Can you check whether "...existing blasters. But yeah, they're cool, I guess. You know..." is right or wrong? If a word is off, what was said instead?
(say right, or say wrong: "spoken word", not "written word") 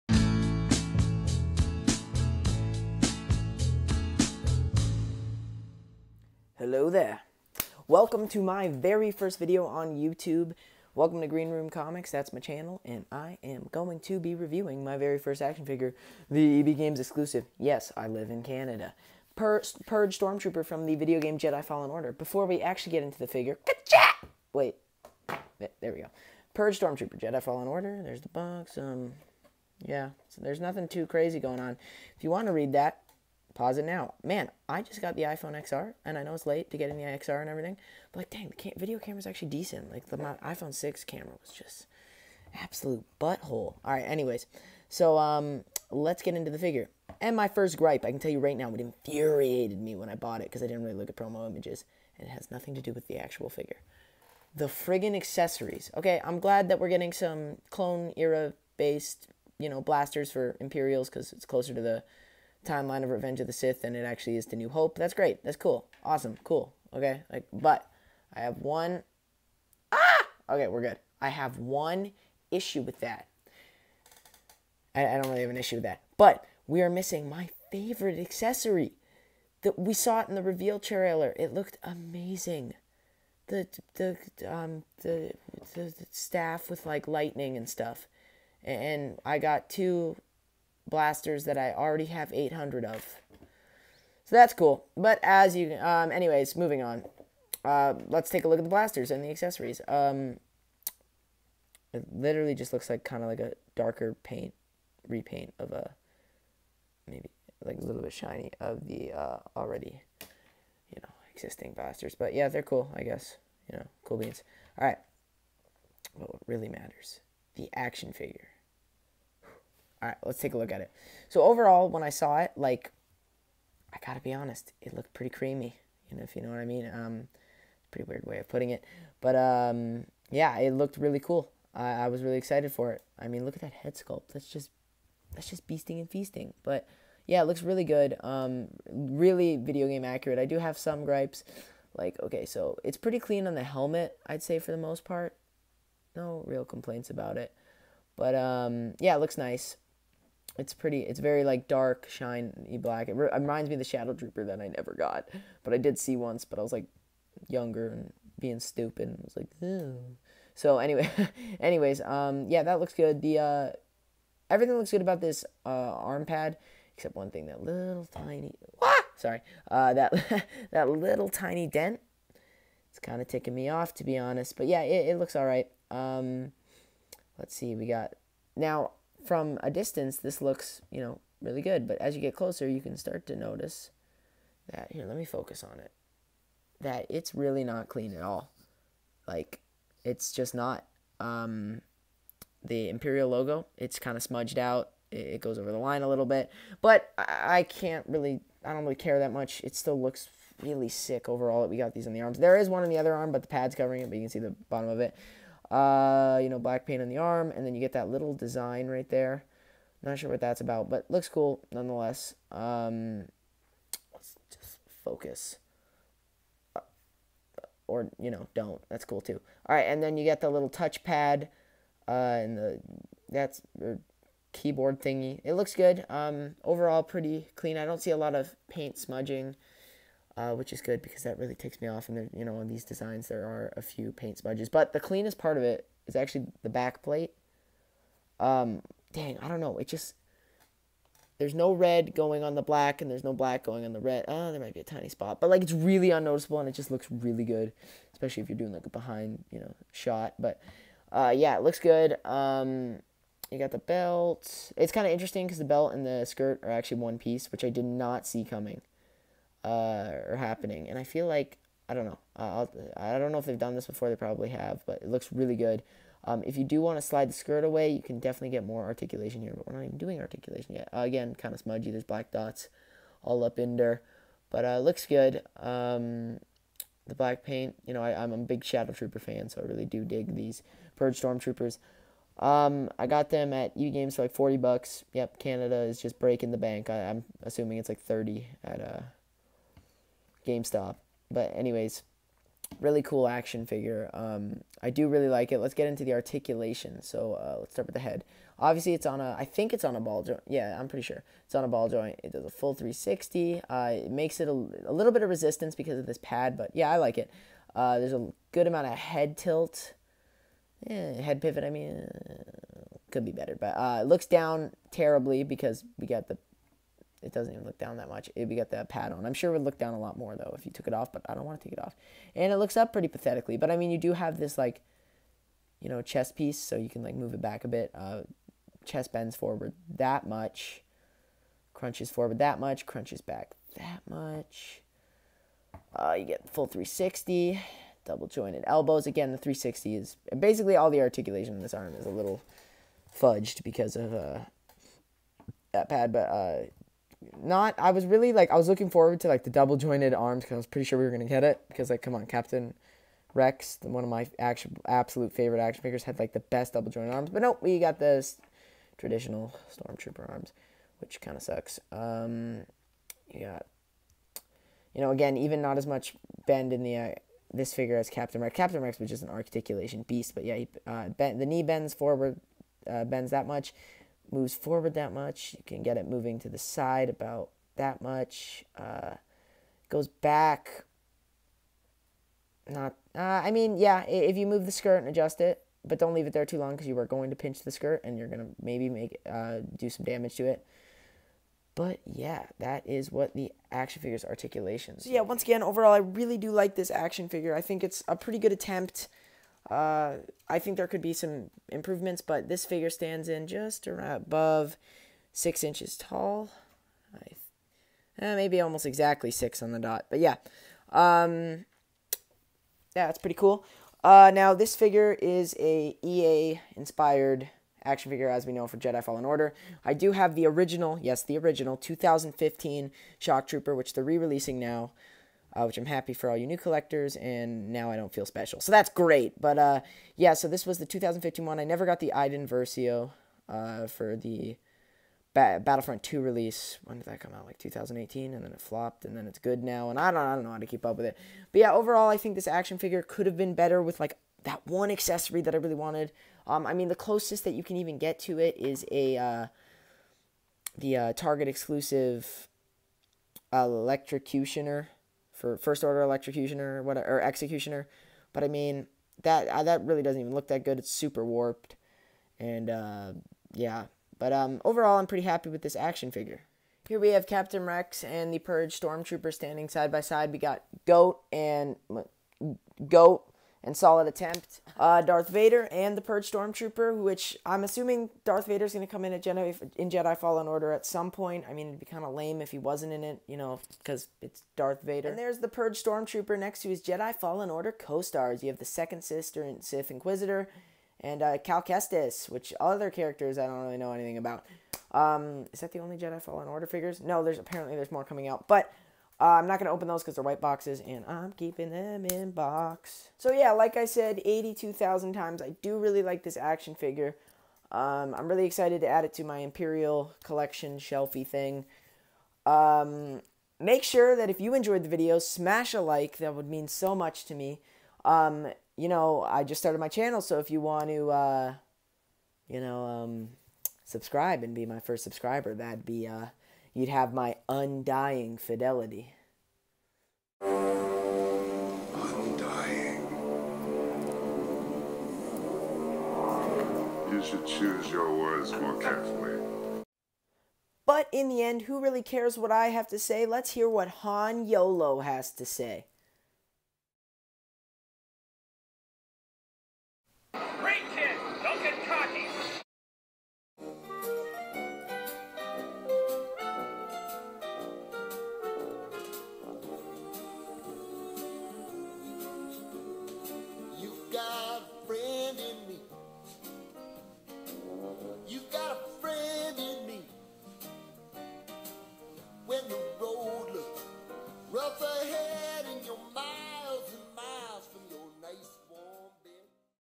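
right.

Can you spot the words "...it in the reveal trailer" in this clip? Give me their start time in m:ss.
1:20.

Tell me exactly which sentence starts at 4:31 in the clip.
There's black dots all up in there, but uh, looks good.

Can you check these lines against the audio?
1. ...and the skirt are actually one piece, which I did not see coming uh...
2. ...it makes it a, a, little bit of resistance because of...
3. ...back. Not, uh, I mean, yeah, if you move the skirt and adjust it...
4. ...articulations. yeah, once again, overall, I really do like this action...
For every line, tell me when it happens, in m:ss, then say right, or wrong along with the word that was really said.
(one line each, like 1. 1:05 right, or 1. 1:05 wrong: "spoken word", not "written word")
1. 4:15 right
2. 5:04 right
3. 6:20 right
4. 6:34 right.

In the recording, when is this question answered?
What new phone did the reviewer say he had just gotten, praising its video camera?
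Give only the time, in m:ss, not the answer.
0:35.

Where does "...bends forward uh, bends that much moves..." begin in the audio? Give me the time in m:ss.
6:11.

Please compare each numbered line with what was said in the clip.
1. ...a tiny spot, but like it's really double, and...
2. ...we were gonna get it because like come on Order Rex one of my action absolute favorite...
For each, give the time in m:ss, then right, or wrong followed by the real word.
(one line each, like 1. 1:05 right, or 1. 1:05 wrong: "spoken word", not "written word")
1. 4:04 wrong: "unnoticeable", not "double"
2. 5:50 wrong: "Captain", not "Order".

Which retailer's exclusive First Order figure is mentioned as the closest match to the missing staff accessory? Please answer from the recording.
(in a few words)
Target.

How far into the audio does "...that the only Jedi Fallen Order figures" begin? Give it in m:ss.
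8:15.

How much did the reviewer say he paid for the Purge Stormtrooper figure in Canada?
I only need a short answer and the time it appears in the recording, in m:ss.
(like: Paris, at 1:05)
40 dollars, at 4:44.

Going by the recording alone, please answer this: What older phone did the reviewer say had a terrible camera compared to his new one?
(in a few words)
iPhone 6.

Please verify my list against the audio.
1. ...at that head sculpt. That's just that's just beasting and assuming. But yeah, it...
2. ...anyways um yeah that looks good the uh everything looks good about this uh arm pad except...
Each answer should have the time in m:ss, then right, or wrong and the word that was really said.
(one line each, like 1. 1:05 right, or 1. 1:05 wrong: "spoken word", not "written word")
1. 2:13 wrong: "feasting", not "assuming"
2. 2:41 right.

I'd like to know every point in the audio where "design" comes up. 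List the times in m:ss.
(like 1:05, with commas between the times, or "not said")
3:28, 3:52.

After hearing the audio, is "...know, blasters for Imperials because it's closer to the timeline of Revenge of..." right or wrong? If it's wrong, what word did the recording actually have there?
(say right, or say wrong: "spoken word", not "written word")
right.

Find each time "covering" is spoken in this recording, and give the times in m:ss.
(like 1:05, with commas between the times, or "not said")
3:23.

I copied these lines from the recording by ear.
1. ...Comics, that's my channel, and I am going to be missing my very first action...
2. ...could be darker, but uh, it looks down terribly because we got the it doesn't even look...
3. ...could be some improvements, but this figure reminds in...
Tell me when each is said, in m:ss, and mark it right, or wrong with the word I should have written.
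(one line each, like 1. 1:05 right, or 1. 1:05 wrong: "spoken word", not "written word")
1. 0:11 wrong: "reviewing", not "missing"
2. 5:13 wrong: "better", not "darker"
3. 6:40 wrong: "stands", not "reminds".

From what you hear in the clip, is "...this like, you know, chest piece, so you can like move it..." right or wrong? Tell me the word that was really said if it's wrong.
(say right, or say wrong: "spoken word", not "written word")
right.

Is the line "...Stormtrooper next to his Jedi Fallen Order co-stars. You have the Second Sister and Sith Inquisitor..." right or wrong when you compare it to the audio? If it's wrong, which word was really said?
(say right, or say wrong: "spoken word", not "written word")
right.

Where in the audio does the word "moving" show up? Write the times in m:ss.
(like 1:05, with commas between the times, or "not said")
1:36, 6:16.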